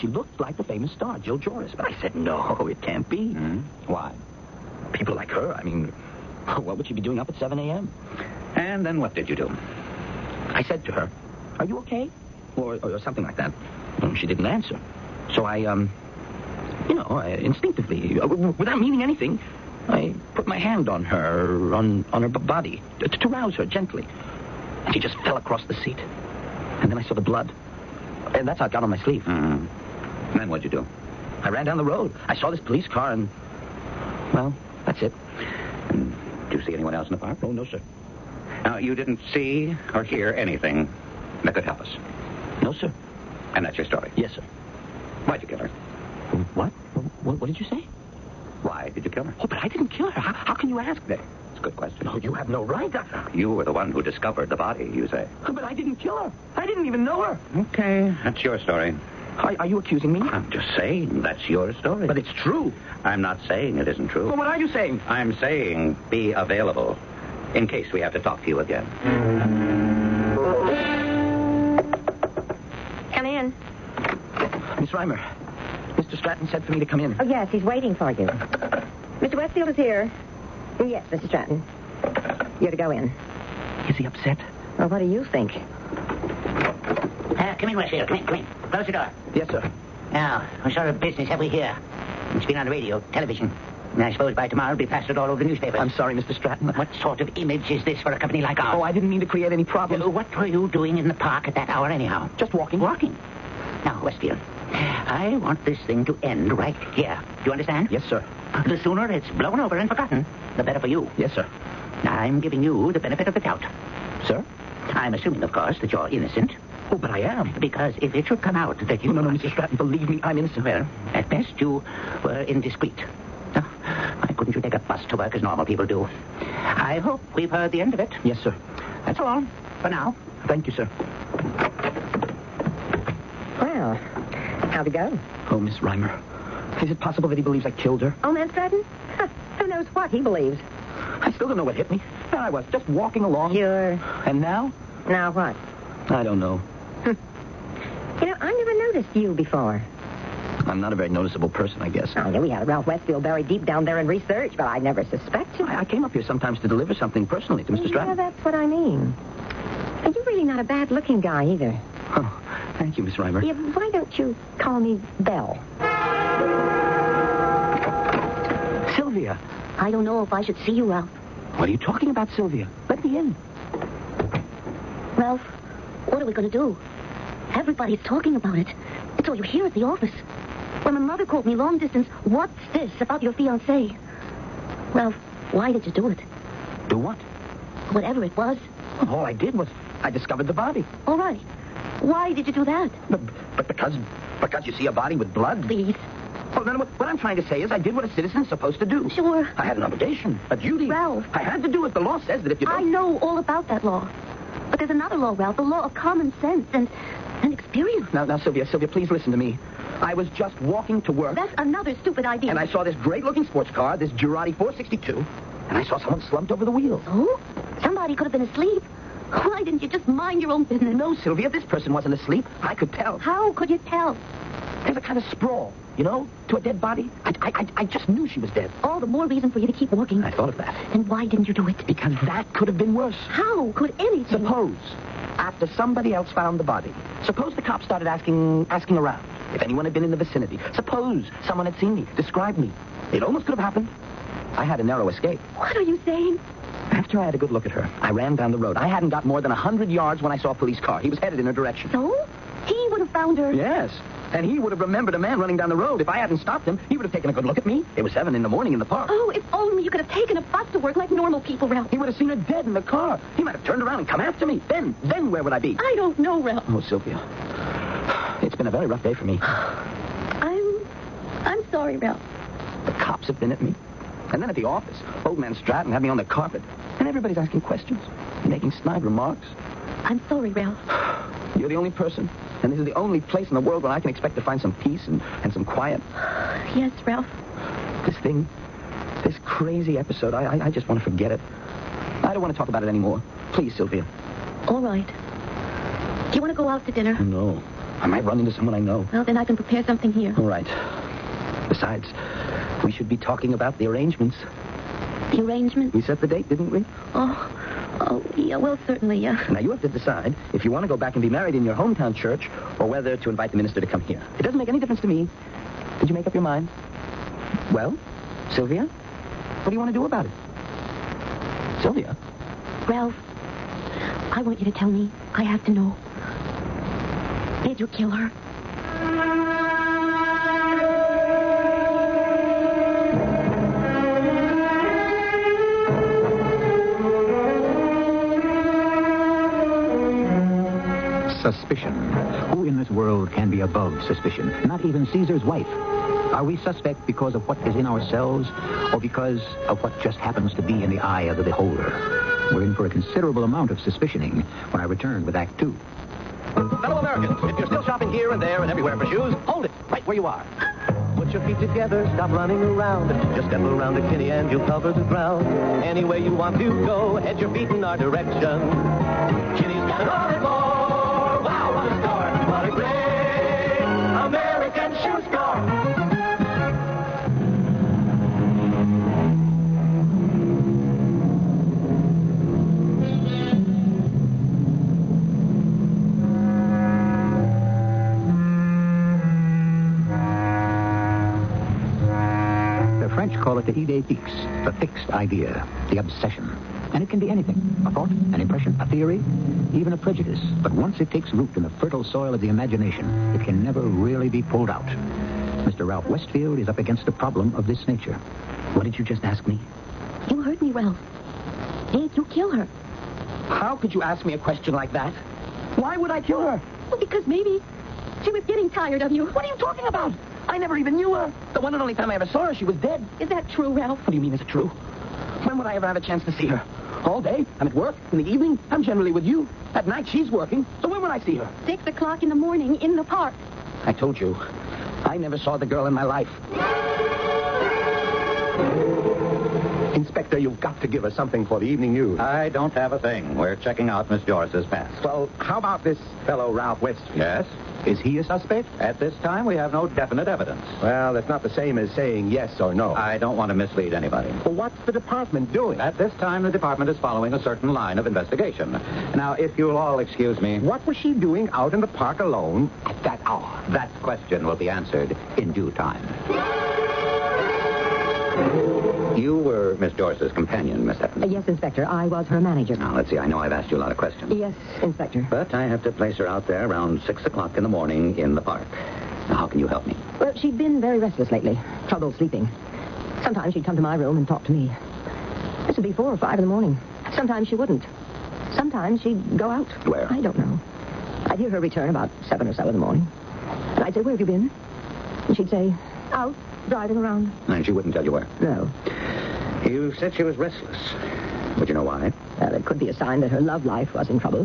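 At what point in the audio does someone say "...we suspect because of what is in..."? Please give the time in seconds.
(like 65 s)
346 s.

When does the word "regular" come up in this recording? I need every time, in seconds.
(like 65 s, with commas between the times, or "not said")
not said.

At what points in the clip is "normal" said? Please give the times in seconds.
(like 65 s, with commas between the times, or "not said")
125 s, 261 s.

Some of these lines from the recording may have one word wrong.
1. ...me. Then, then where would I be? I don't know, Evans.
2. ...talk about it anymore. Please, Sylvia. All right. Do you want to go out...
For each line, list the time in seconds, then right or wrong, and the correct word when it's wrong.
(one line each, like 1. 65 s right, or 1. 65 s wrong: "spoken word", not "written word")
1. 264 s wrong: "Ralph", not "Evans"
2. 292 s right.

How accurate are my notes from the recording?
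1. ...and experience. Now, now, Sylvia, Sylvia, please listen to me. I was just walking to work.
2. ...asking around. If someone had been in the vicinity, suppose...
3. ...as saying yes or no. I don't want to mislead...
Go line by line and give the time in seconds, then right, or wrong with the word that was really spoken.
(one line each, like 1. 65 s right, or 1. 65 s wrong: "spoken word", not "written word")
1. 207 s right
2. 238 s wrong: "anyone", not "someone"
3. 451 s right.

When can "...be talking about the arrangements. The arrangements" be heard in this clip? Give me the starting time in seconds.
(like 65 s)
303 s.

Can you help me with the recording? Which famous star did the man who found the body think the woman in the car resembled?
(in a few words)
Jill Joris.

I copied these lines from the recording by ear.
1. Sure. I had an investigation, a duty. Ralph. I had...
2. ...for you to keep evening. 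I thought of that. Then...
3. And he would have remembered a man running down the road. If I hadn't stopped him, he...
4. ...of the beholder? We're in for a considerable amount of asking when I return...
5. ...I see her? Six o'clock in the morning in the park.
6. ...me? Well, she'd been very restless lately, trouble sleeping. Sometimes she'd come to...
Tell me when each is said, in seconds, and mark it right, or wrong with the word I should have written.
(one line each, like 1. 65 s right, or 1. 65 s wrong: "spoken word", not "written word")
1. 199 s wrong: "obligation", not "investigation"
2. 229 s wrong: "walking", not "evening"
3. 254 s right
4. 351 s wrong: "suspicioning", not "asking"
5. 431 s right
6. 479 s right.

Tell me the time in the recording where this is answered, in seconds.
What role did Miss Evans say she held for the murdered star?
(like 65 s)
472 s.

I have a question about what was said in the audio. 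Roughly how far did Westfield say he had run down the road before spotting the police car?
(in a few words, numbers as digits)
100 yards.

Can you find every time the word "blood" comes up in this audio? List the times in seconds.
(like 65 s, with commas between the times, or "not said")
27 s, 195 s.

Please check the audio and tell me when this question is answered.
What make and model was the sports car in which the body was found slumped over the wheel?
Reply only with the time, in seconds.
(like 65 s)
214 s.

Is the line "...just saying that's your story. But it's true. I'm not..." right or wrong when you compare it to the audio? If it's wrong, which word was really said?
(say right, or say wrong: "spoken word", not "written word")
right.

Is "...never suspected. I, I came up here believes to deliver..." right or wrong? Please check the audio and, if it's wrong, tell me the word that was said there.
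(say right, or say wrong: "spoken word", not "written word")
wrong: "sometimes", not "believes".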